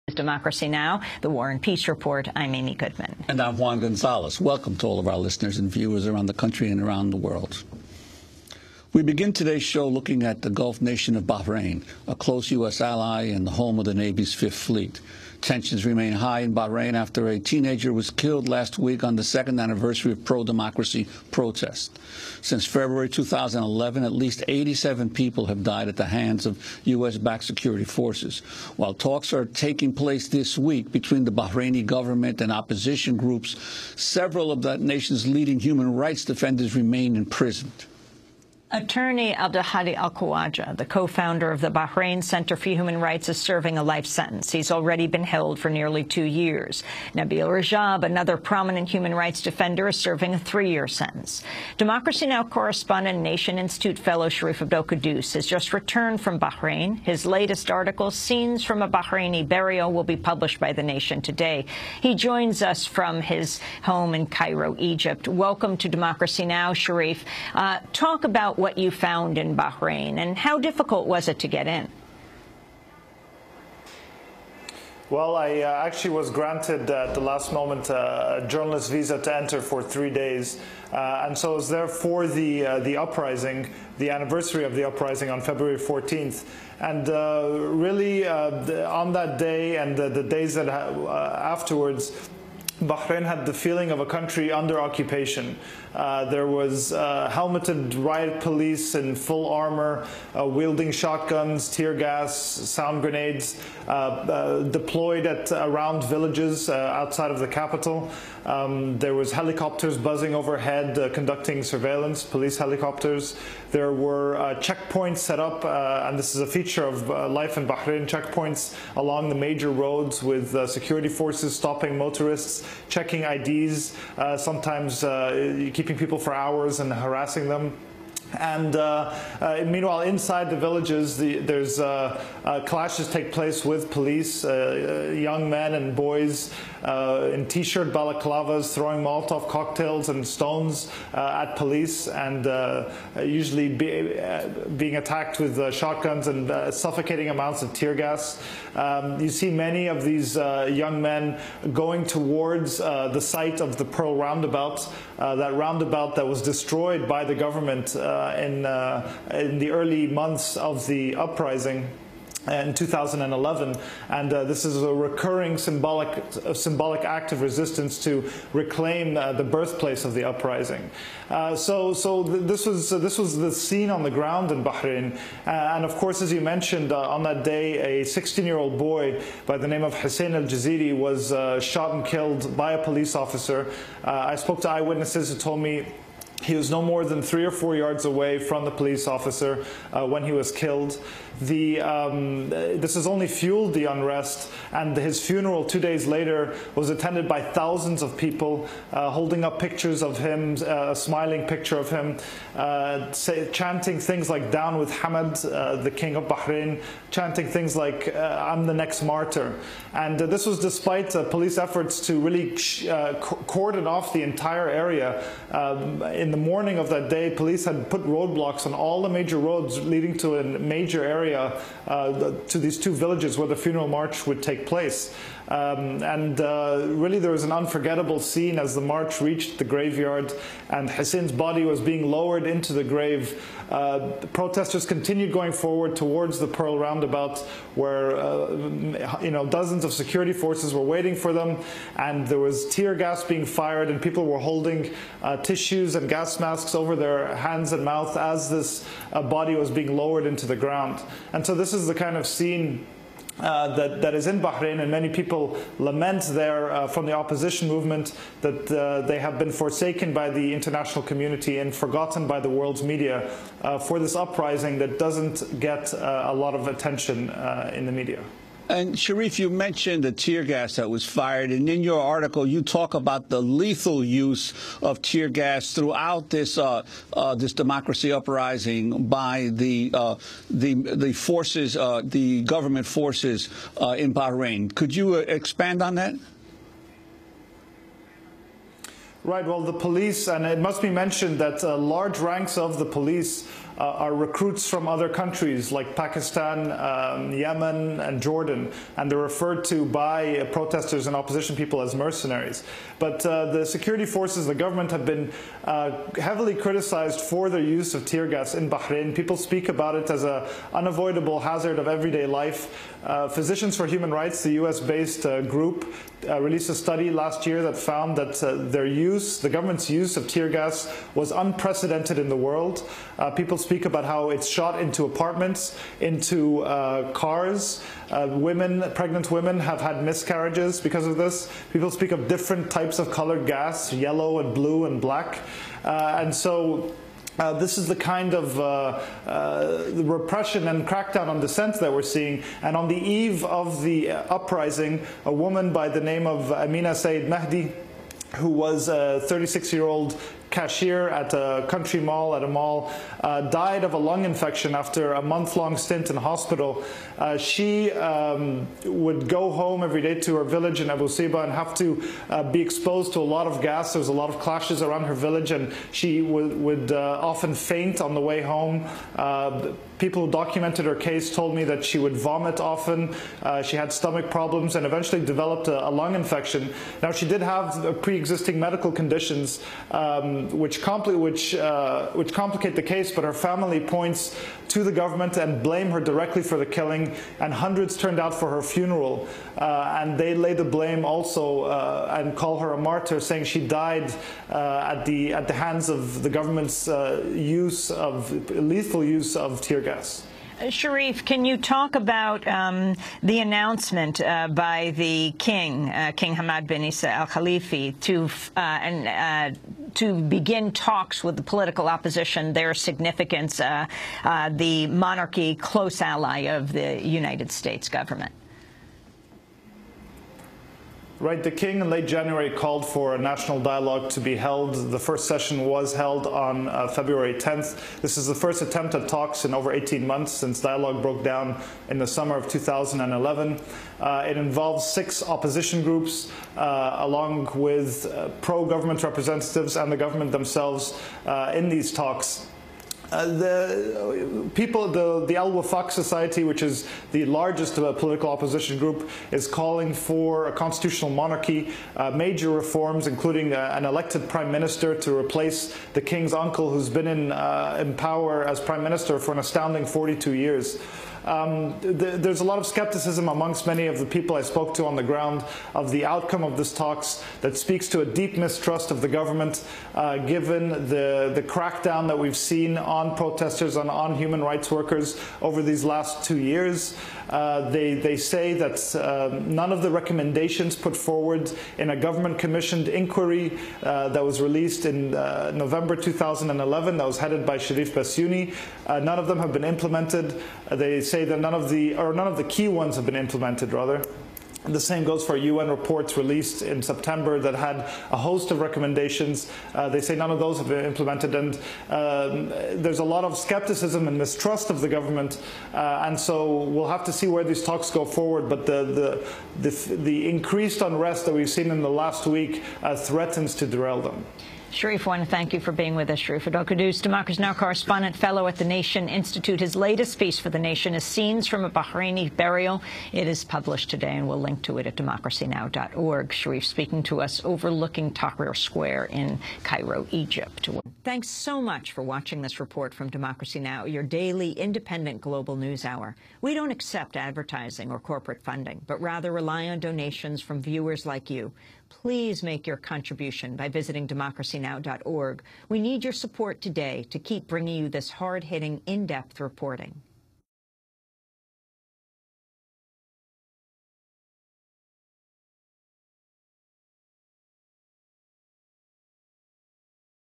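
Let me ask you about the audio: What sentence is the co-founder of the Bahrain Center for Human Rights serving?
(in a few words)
Life sentence.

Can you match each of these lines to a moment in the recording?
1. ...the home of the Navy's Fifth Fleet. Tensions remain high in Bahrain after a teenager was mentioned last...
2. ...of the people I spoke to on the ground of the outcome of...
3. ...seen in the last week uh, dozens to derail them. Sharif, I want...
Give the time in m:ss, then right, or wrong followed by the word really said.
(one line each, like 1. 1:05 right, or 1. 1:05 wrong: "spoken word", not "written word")
1. 0:13 wrong: "killed", not "mentioned"
2. 7:43 right
3. 8:31 wrong: "threatens", not "dozens".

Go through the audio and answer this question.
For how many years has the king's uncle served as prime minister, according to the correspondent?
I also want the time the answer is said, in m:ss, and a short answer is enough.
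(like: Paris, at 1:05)
42, at 7:39.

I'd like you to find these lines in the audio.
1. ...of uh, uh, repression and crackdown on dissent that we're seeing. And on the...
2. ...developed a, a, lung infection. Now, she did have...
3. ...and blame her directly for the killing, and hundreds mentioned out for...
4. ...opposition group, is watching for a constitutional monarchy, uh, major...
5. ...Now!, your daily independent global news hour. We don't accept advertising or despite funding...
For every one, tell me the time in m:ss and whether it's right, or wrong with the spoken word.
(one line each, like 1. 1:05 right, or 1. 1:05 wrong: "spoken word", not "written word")
1. 5:38 right
2. 6:15 right
3. 6:25 wrong: "turned", not "mentioned"
4. 7:28 wrong: "calling", not "watching"
5. 8:53 wrong: "corporate", not "despite".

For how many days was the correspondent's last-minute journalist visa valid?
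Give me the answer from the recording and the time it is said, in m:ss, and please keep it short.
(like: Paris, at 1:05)
3, at 1:19.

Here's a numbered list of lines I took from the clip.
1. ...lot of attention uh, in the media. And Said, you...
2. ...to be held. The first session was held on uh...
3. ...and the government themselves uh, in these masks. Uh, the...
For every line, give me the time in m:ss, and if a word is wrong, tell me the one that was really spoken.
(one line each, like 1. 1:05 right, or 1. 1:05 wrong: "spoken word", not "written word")
1. 4:26 wrong: "Sharif", not "Said"
2. 7:04 right
3. 7:19 wrong: "talks", not "masks".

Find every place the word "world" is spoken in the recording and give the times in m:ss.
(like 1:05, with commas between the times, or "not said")
0:07, 4:22, 5:22.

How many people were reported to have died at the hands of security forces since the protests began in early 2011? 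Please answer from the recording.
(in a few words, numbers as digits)
87.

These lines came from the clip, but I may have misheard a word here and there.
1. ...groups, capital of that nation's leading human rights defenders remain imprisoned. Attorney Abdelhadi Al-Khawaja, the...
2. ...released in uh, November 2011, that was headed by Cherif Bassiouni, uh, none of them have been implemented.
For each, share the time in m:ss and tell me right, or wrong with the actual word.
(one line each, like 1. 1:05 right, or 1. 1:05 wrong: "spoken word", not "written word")
1. 0:33 wrong: "several", not "capital"
2. 8:04 right.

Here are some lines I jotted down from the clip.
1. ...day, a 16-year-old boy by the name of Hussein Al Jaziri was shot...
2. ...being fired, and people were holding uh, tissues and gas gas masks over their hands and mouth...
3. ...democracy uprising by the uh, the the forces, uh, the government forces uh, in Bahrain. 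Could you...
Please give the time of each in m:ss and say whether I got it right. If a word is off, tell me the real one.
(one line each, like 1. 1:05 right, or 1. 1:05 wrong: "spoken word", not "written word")
1. 2:57 right
2. 4:03 right
3. 4:37 right.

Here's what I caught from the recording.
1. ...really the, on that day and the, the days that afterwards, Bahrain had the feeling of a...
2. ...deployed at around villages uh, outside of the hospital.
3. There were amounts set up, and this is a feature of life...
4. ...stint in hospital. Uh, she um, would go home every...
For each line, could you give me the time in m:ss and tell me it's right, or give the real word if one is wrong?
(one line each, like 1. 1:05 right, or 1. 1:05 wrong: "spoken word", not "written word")
1. 1:27 right
2. 1:44 wrong: "capital", not "hospital"
3. 1:53 wrong: "checkpoints", not "amounts"
4. 5:55 right.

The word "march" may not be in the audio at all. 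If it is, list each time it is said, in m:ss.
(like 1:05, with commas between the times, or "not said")
3:43, 3:48.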